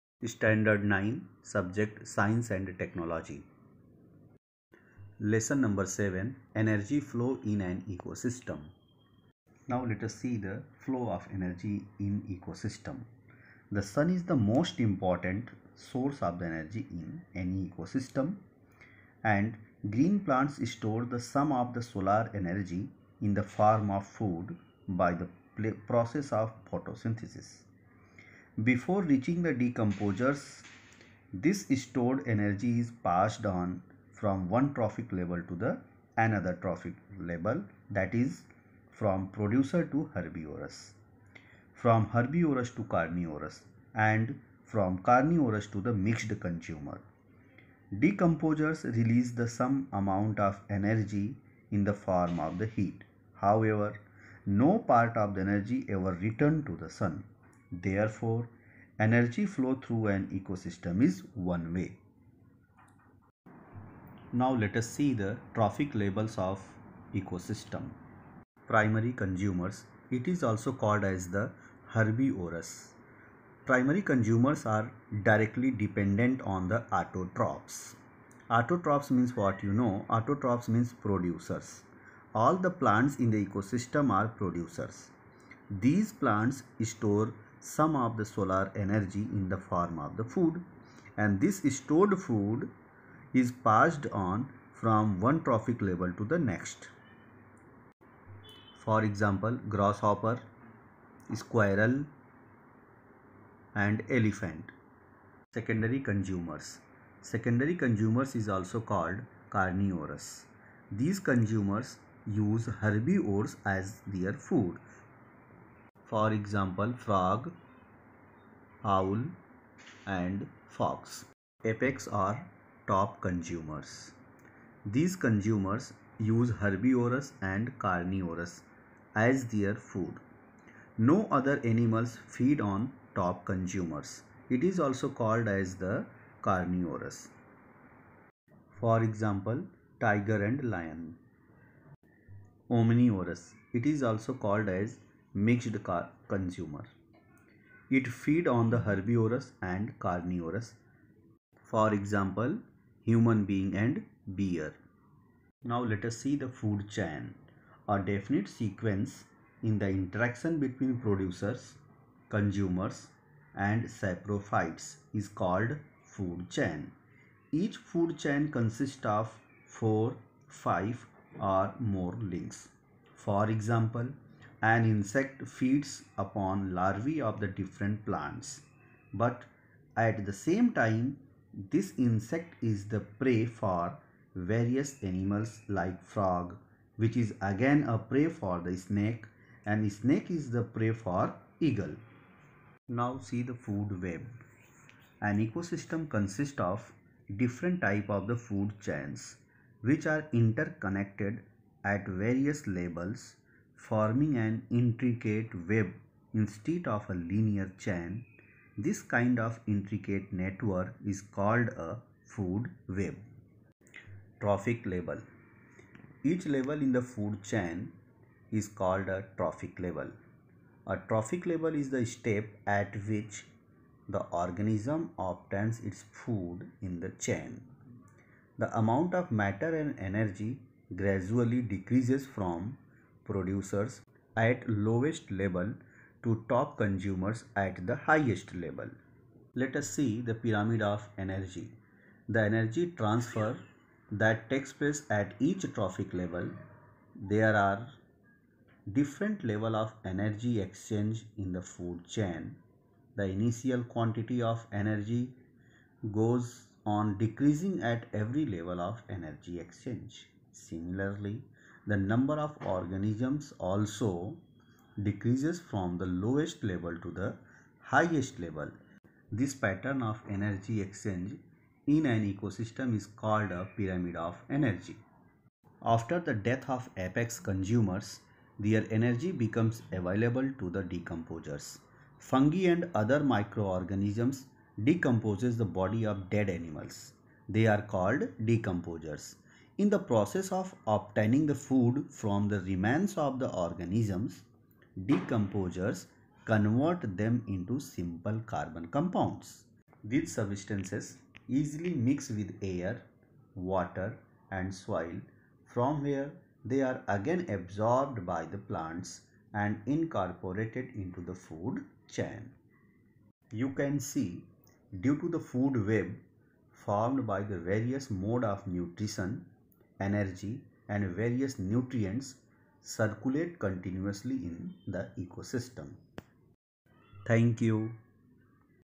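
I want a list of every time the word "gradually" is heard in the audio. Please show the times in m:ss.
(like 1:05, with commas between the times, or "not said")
3:50.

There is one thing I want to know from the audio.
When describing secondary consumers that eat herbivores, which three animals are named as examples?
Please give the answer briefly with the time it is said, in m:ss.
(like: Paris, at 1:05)
Frog, owl and fox, at 1:57.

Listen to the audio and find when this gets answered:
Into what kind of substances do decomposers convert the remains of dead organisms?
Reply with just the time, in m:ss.
4:57.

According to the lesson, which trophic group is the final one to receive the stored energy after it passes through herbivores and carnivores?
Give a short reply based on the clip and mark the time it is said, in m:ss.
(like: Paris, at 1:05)
Mixed consumer, at 0:45.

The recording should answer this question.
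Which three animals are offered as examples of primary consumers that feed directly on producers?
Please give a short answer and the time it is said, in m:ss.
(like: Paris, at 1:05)
Grasshopper, squirrel and elephant, at 1:39.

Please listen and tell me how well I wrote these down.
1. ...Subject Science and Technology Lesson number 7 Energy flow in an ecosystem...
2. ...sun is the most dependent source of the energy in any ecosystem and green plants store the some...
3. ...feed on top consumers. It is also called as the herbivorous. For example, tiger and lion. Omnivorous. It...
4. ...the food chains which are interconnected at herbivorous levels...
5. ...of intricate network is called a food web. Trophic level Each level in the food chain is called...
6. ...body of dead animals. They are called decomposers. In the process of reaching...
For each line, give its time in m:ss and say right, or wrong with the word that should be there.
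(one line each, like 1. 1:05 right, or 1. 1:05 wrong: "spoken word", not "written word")
1. 0:01 right
2. 0:13 wrong: "important", not "dependent"
3. 2:12 wrong: "carnivorous", not "herbivorous"
4. 3:18 wrong: "various", not "herbivorous"
5. 3:29 right
6. 4:45 wrong: "obtaining", not "reaching".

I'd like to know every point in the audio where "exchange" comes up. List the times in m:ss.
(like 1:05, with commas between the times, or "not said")
4:10, 4:19, 4:30.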